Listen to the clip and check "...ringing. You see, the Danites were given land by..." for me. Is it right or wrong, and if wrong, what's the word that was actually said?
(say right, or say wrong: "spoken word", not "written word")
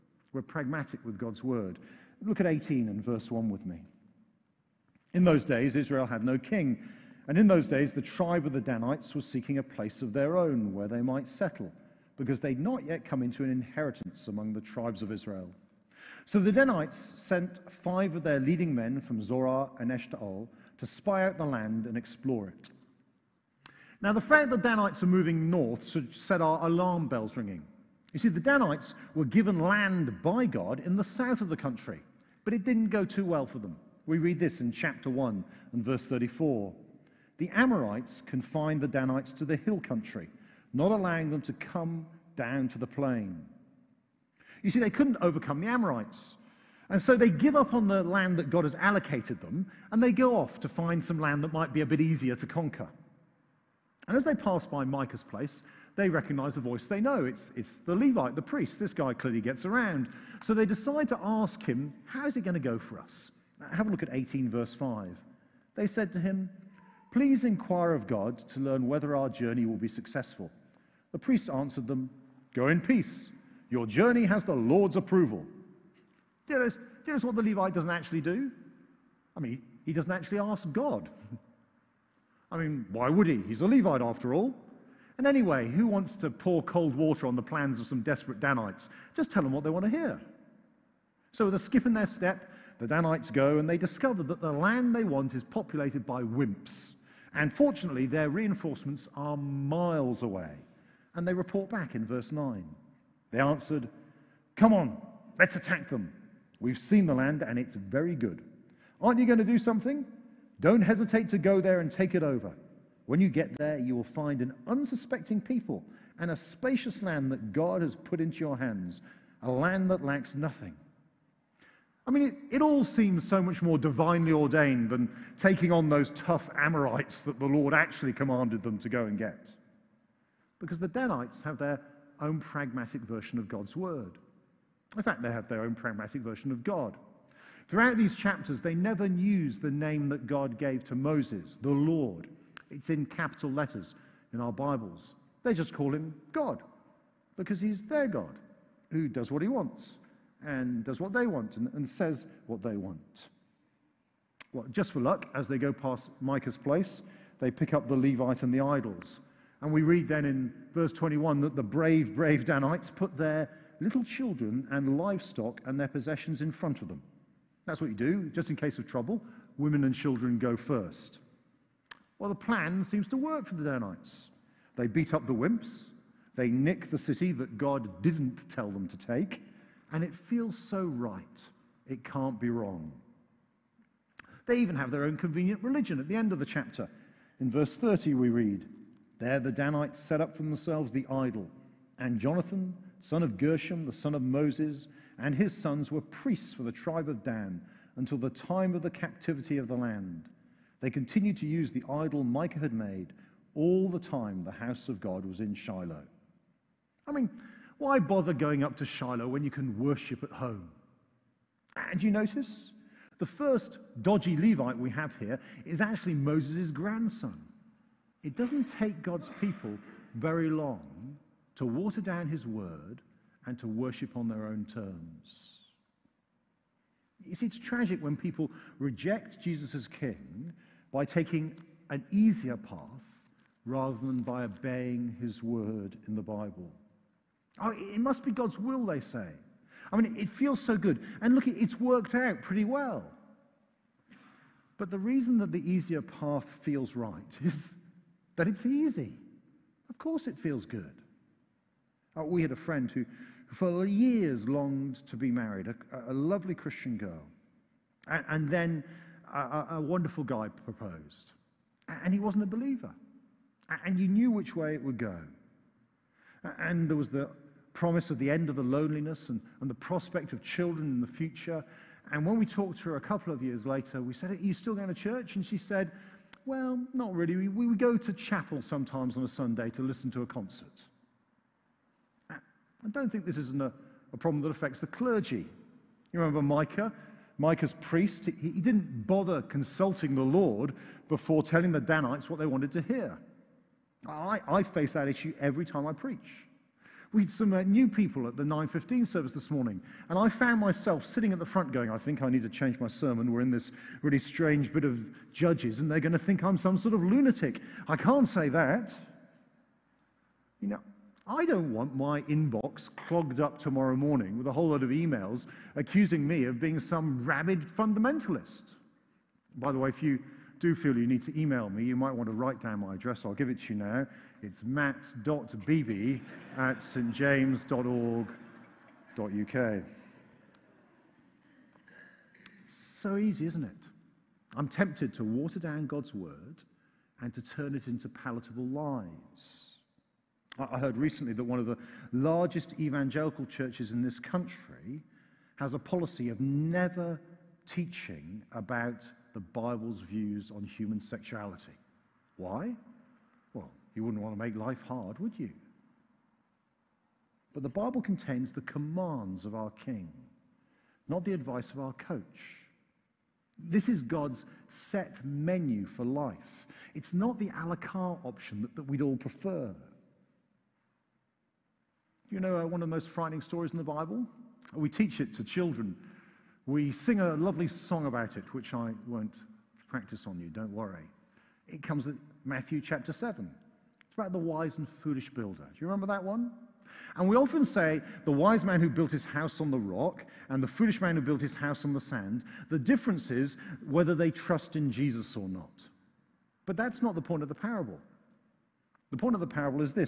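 right.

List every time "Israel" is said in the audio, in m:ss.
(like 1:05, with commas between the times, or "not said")
0:05, 0:15.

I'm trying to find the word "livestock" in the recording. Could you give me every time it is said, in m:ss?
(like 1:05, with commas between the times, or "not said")
2:44.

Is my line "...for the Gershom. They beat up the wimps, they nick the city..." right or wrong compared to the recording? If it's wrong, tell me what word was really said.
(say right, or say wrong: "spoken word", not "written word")
wrong: "Danites", not "Gershom".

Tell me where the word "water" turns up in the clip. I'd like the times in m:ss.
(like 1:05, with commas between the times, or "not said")
1:26, 3:41, 5:35.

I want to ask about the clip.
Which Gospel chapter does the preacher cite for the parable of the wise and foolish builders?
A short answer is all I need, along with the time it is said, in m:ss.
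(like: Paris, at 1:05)
Matthew chapter 7, at 6:22.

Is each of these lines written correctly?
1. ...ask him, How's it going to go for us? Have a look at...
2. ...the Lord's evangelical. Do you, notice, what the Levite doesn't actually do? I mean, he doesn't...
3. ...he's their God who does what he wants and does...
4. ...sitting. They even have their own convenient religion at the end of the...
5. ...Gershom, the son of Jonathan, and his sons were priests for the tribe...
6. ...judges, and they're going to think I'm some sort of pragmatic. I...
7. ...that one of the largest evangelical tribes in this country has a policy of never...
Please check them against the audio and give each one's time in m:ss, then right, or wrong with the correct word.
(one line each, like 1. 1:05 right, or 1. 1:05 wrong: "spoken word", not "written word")
1. 1:01 right
2. 1:14 wrong: "approval", not "evangelical"
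3. 2:27 right
4. 3:02 wrong: "wrong", not "sitting"
5. 3:13 wrong: "Moses", not "Jonathan"
6. 5:05 wrong: "lunatic", not "pragmatic"
7. 5:41 wrong: "churches", not "tribes".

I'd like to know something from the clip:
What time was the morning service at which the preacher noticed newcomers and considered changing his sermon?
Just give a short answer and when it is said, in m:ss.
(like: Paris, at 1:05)
9.15, at 4:58.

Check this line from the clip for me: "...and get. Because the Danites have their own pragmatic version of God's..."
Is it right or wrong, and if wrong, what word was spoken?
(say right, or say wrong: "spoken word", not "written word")
right.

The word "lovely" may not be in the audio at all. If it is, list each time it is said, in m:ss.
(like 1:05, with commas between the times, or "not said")
4:16, 6:17.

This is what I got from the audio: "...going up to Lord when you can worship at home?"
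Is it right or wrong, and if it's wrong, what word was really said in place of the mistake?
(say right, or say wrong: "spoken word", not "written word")
wrong: "Shiloh", not "Lord".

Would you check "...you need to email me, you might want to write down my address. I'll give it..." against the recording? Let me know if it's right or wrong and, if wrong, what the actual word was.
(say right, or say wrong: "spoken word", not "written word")
right.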